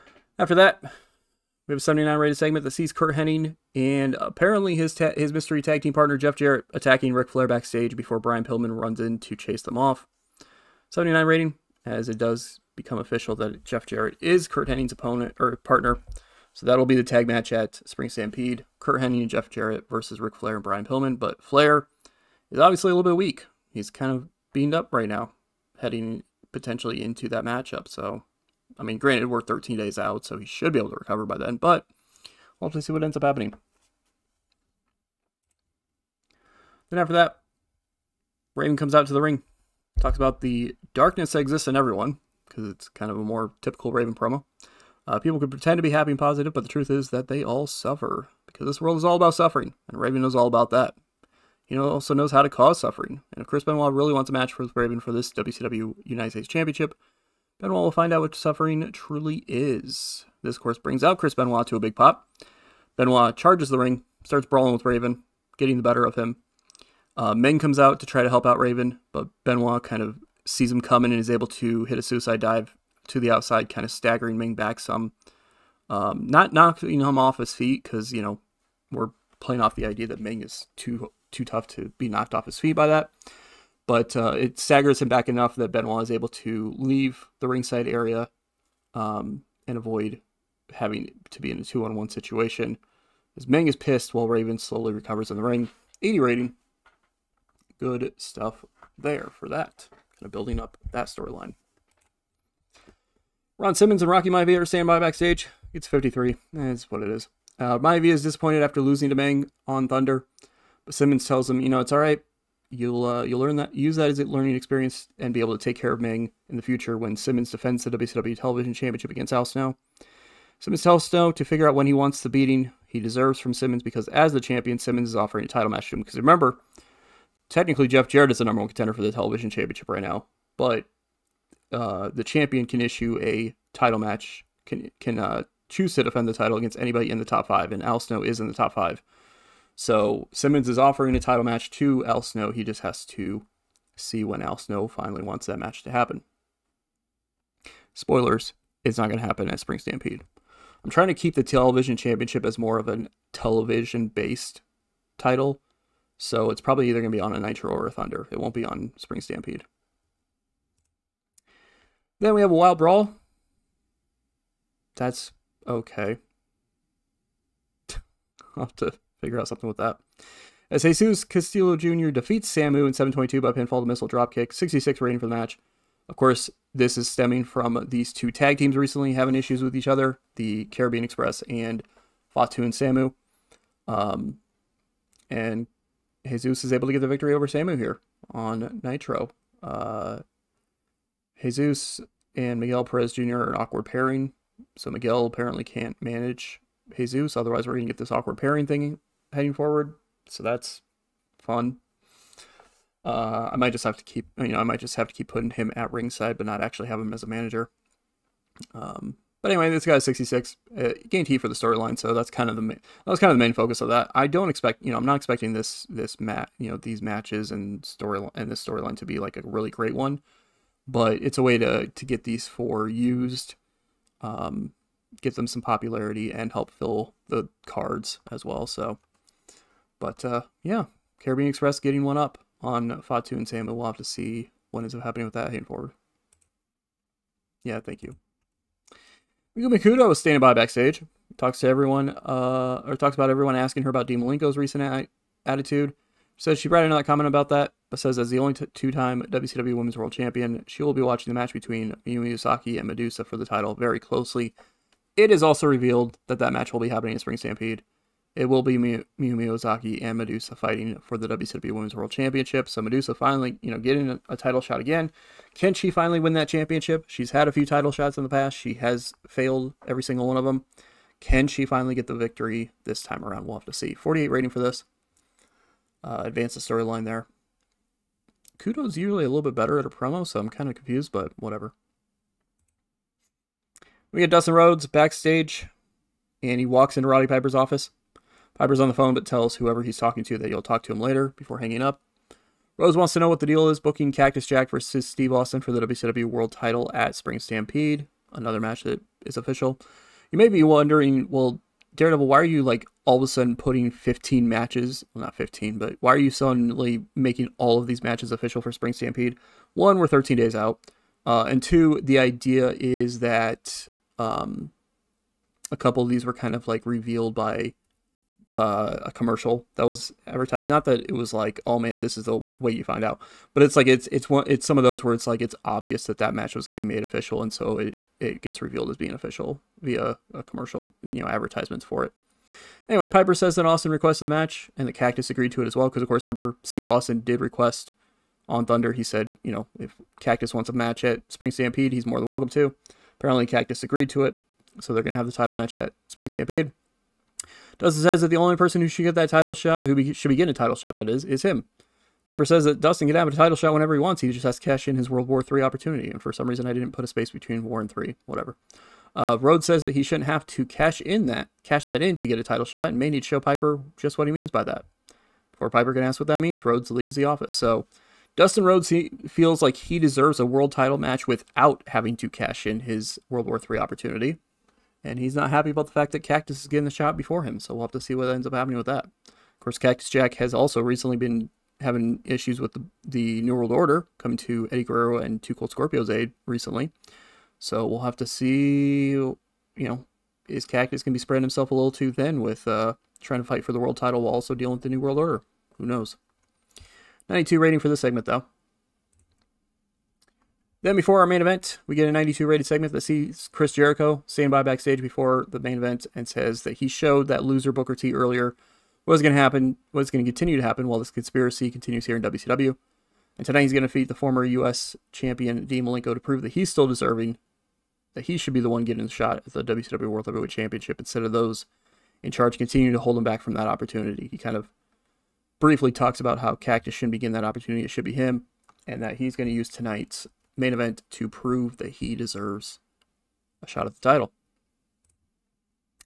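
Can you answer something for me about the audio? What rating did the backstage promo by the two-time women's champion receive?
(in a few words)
48.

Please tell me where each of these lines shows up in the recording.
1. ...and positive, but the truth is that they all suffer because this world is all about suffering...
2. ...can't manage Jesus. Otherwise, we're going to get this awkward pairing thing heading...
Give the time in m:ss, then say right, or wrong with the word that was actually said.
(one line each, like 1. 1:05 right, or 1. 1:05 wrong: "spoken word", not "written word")
1. 0:46 right
2. 3:15 right.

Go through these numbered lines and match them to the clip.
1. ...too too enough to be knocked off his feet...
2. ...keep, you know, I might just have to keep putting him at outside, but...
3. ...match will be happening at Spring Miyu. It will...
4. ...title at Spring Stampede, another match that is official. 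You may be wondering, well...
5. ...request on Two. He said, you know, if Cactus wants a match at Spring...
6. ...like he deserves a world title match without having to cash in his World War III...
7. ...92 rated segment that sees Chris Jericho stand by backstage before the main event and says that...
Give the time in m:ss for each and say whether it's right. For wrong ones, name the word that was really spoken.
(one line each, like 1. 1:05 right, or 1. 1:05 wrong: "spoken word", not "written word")
1. 1:20 wrong: "tough", not "enough"
2. 3:24 wrong: "ringside", not "outside"
3. 4:16 wrong: "Stampede", not "Miyu"
4. 4:56 right
5. 5:37 wrong: "Thunder", not "Two"
6. 6:09 right
7. 6:42 right.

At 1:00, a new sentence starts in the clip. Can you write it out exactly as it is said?
This, of course, brings out Chris Benoit to a big pop.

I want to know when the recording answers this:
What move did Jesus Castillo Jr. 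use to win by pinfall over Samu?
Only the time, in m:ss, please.
2:53.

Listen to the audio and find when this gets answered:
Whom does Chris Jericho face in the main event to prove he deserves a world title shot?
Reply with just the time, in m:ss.
6:55.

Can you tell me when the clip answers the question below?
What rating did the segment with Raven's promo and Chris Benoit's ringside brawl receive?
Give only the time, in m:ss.
1:36.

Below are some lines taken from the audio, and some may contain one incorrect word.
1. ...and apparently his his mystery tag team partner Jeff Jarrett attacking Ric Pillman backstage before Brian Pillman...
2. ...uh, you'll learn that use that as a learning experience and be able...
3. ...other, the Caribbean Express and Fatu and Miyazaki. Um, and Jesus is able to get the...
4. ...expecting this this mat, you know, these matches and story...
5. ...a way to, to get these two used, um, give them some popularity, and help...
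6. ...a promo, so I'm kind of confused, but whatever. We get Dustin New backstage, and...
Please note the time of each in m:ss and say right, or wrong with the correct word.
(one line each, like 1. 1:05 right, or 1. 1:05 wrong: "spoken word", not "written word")
1. 0:03 wrong: "Flair", not "Pillman"
2. 1:53 right
3. 2:59 wrong: "Samu", not "Miyazaki"
4. 3:35 right
5. 3:41 wrong: "four", not "two"
6. 4:39 wrong: "Rhodes", not "New".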